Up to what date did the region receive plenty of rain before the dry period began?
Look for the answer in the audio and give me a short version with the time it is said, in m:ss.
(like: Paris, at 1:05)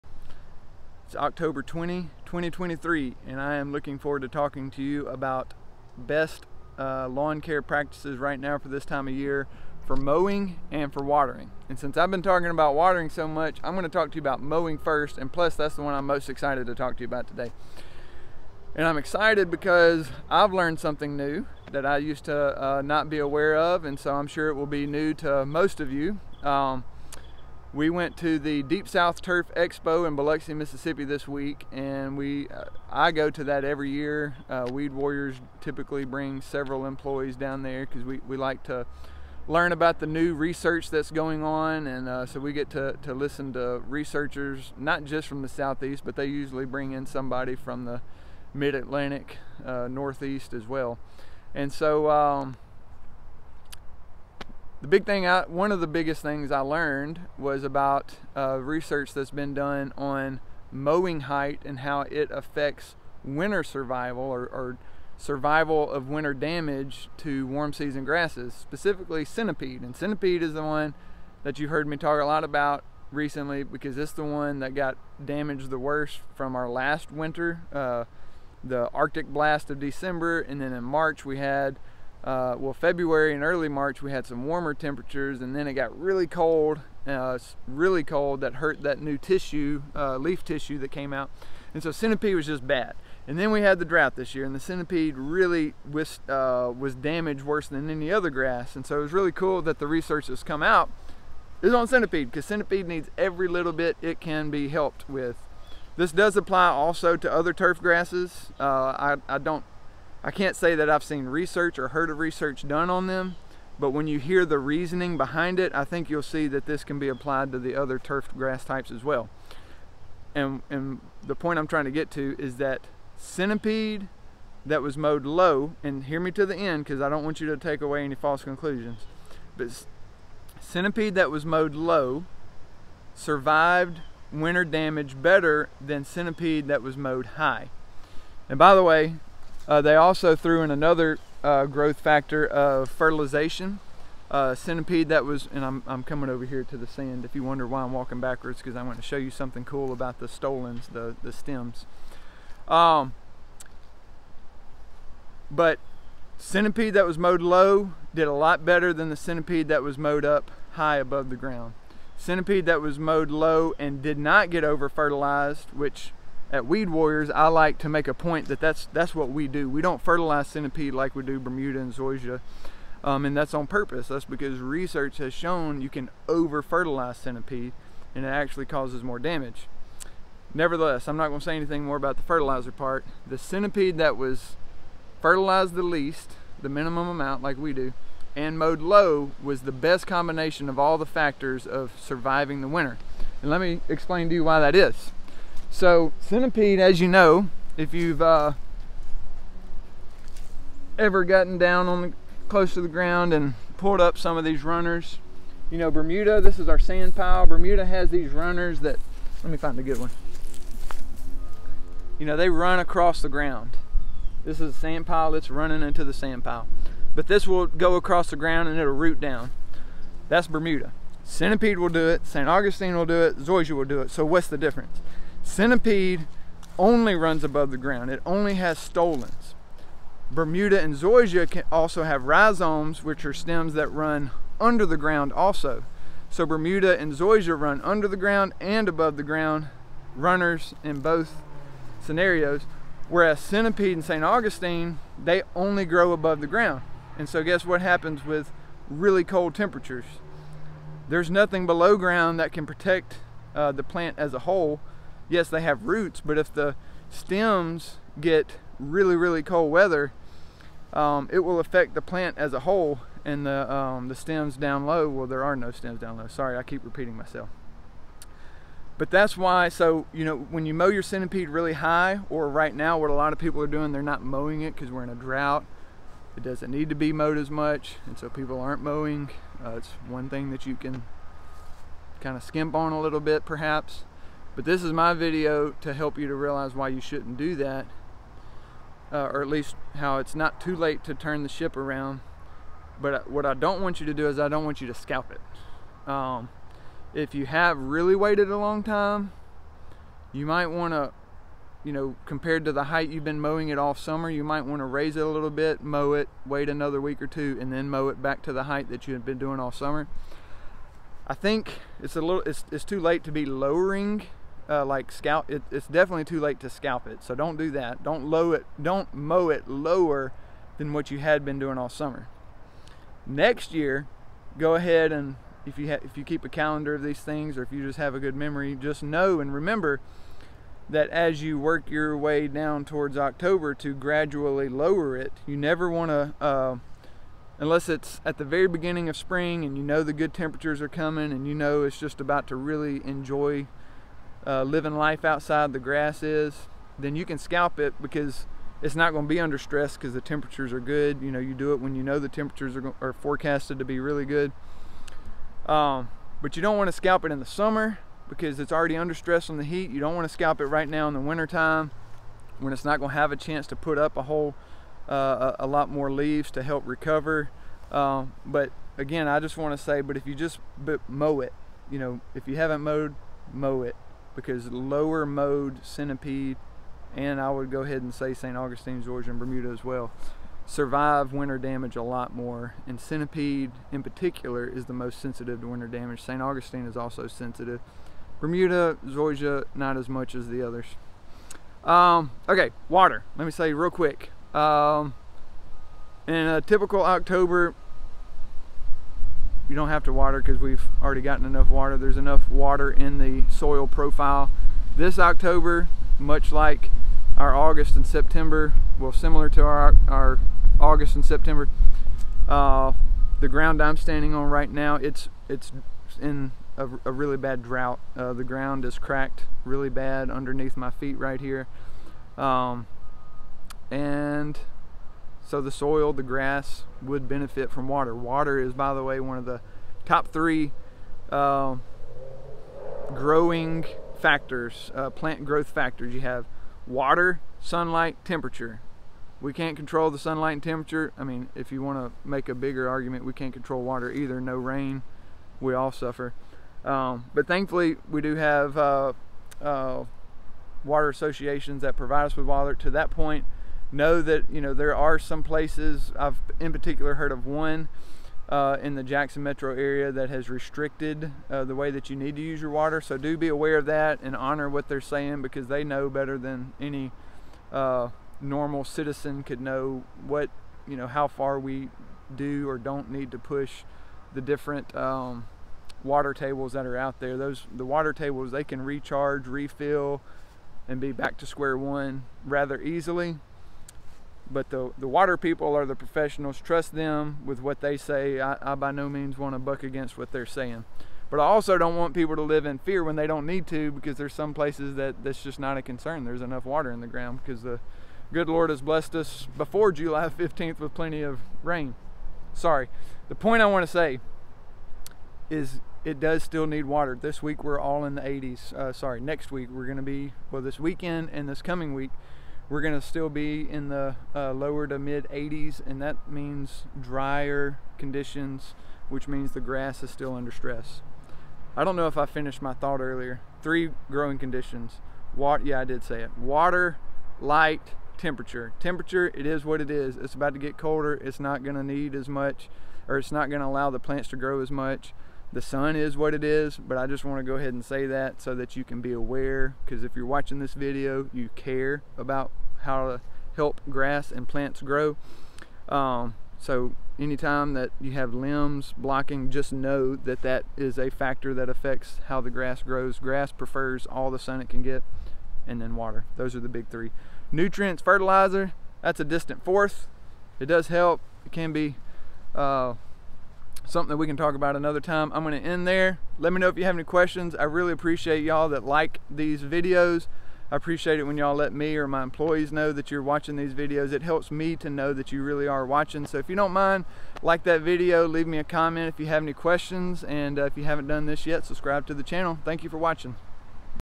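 July 15th, at 8:19.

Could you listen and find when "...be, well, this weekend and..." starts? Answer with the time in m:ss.
8:30.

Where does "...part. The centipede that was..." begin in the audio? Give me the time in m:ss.
3:02.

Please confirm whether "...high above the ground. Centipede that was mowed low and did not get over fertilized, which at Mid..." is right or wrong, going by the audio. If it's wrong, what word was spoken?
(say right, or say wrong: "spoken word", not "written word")
wrong: "Weed", not "Mid".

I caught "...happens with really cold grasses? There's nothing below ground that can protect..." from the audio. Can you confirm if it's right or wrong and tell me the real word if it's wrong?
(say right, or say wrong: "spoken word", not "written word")
wrong: "temperatures", not "grasses".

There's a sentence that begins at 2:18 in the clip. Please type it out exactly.
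And by the way, uh, they also threw in another uh, growth factor of fertilization.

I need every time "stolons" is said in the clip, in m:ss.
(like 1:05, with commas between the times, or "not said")
2:30, 3:48.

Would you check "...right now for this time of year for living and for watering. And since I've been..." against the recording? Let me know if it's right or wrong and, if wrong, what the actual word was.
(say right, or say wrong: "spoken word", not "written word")
wrong: "mowing", not "living".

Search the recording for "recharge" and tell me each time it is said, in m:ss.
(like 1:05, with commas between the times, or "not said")
7:58.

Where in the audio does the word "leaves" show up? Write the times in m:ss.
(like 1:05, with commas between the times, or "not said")
6:06, 9:38.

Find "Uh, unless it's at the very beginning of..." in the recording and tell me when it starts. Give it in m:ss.
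5:36.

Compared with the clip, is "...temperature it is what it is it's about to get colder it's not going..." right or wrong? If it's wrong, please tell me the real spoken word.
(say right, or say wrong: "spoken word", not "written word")
right.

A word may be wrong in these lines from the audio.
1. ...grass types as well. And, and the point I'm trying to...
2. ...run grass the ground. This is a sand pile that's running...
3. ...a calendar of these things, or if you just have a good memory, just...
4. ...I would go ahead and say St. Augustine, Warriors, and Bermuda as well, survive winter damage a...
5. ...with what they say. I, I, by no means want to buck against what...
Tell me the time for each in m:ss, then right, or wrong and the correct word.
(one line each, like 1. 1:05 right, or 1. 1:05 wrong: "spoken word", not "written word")
1. 1:58 right
2. 3:32 wrong: "across", not "grass"
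3. 5:26 right
4. 6:17 wrong: "Zoysia", not "Warriors"
5. 8:07 right.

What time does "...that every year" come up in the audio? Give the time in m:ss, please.
0:33.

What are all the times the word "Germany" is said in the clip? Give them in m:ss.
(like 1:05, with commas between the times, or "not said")
not said.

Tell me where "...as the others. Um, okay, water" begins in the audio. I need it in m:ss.
6:30.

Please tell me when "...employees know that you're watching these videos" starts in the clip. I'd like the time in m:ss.
9:32.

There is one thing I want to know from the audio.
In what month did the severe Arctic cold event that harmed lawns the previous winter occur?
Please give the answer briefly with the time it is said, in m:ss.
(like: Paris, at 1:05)
December, at 1:19.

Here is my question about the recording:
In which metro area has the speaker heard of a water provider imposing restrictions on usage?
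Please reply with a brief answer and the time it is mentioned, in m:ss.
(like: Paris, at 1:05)
Jackson, at 7:39.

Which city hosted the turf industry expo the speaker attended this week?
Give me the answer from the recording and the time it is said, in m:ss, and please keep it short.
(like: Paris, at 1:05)
Biloxi, Mississippi, at 0:30.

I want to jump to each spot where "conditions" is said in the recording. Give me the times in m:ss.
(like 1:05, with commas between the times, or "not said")
8:37, 8:44.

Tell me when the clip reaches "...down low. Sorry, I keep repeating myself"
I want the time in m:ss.
4:25.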